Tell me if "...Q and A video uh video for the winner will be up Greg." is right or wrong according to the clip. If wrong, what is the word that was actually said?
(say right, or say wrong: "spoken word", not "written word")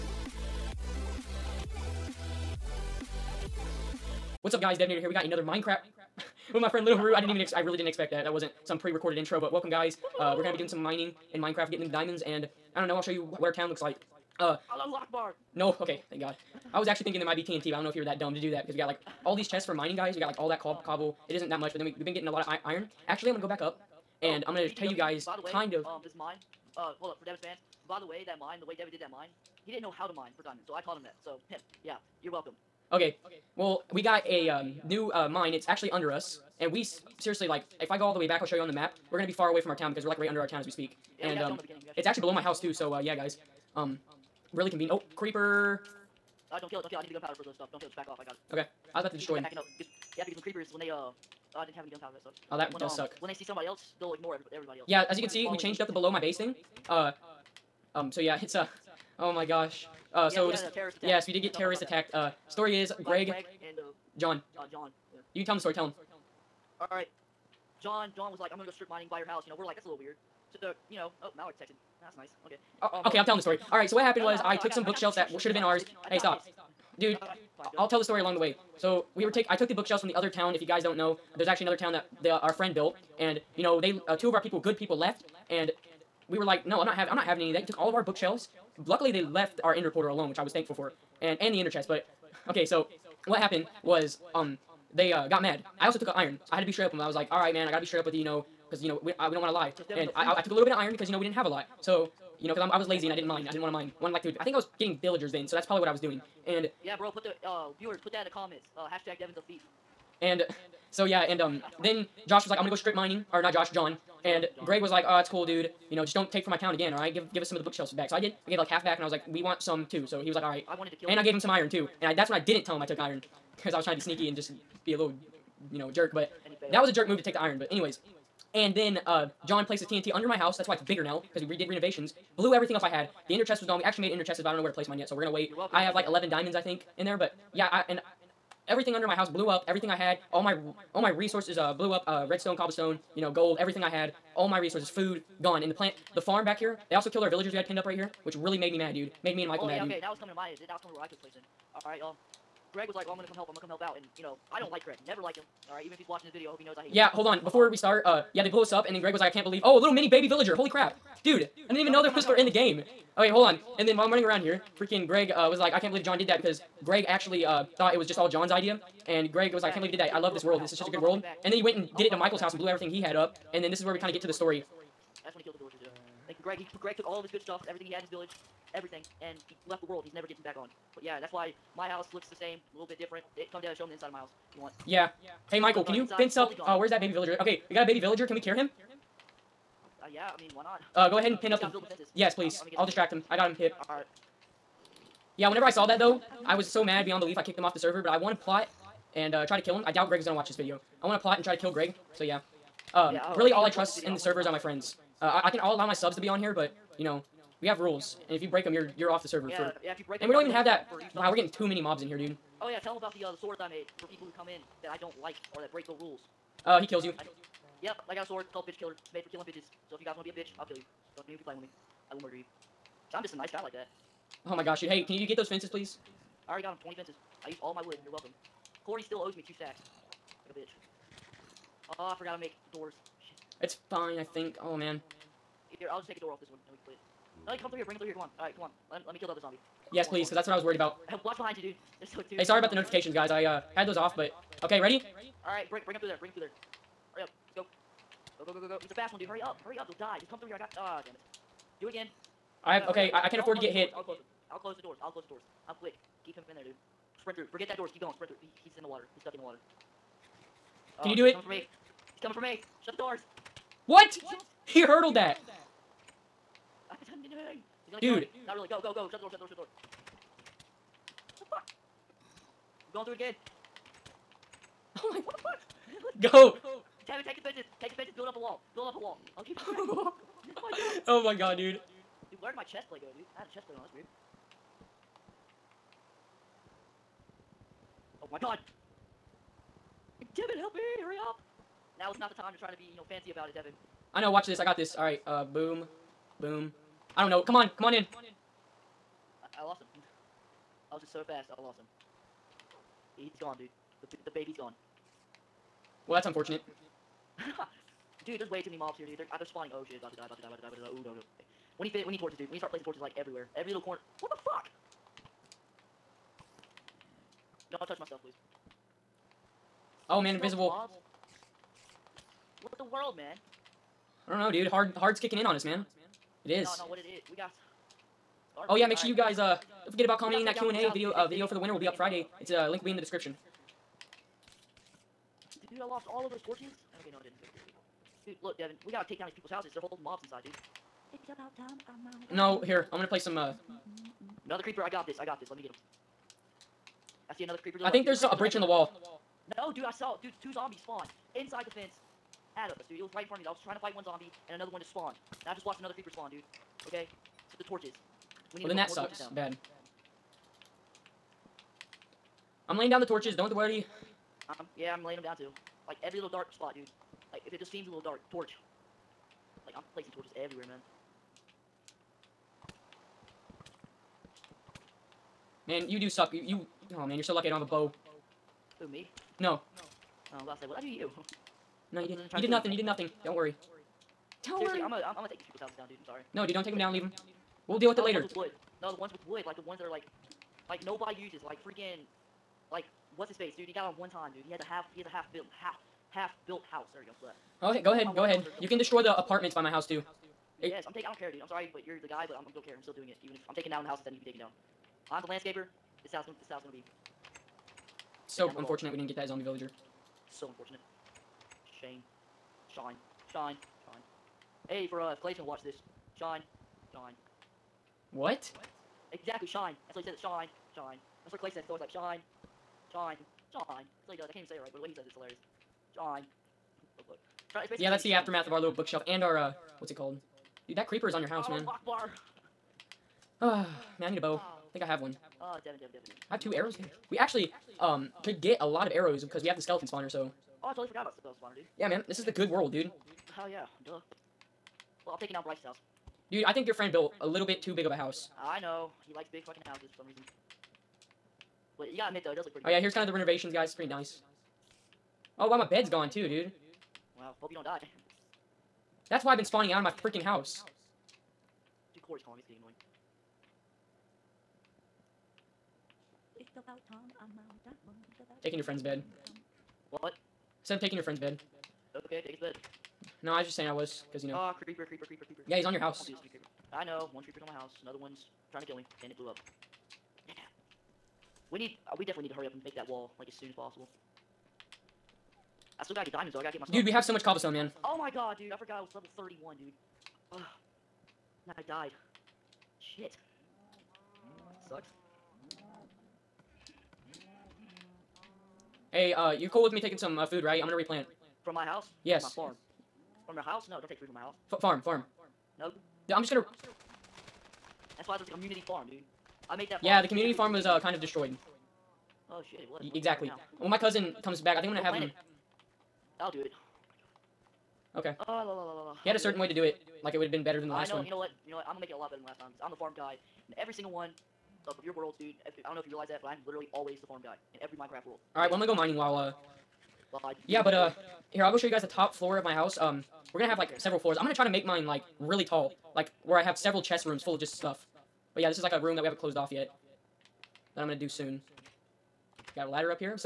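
wrong: "Friday", not "Greg".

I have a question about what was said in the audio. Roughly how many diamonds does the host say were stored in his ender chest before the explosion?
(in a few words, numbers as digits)
11.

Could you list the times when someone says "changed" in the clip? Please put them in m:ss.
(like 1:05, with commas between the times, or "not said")
0:55.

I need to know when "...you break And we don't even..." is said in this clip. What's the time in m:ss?
3:29.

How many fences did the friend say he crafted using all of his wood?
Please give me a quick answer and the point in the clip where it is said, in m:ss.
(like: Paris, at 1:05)
20, at 3:46.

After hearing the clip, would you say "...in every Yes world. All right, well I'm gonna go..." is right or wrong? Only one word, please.
wrong.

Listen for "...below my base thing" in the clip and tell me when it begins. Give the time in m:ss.
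0:55.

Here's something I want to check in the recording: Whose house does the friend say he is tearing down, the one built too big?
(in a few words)
Bryce.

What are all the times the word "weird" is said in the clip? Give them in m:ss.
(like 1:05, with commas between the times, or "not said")
1:09, 4:43.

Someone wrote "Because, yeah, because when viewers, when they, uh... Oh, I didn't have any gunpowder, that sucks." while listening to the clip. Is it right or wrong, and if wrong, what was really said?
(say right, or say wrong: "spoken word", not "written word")
wrong: "creepers", not "viewers".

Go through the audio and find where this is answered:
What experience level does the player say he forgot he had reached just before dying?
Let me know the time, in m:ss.
8:09.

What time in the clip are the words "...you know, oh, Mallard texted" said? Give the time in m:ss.
1:10.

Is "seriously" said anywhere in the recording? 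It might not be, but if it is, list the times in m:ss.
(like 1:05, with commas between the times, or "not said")
0:37, 6:24.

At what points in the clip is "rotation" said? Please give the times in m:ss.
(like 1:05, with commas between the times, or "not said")
not said.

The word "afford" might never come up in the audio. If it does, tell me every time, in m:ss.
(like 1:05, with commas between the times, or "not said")
4:13.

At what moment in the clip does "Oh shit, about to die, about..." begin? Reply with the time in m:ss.
5:09.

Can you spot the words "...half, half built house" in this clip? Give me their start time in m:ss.
6:35.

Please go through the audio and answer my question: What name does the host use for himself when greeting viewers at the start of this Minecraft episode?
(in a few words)
Devanator.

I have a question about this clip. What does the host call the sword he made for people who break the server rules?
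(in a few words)
Bitch Killer.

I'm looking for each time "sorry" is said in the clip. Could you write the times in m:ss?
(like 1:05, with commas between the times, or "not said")
4:02, 6:26, 6:41.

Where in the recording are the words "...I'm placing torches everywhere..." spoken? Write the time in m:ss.
6:09.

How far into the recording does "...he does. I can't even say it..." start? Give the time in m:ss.
7:04.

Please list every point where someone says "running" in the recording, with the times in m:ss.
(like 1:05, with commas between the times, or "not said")
2:44.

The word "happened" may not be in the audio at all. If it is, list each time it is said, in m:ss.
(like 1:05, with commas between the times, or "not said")
1:14, 1:33.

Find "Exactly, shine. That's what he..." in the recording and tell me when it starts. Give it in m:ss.
6:59.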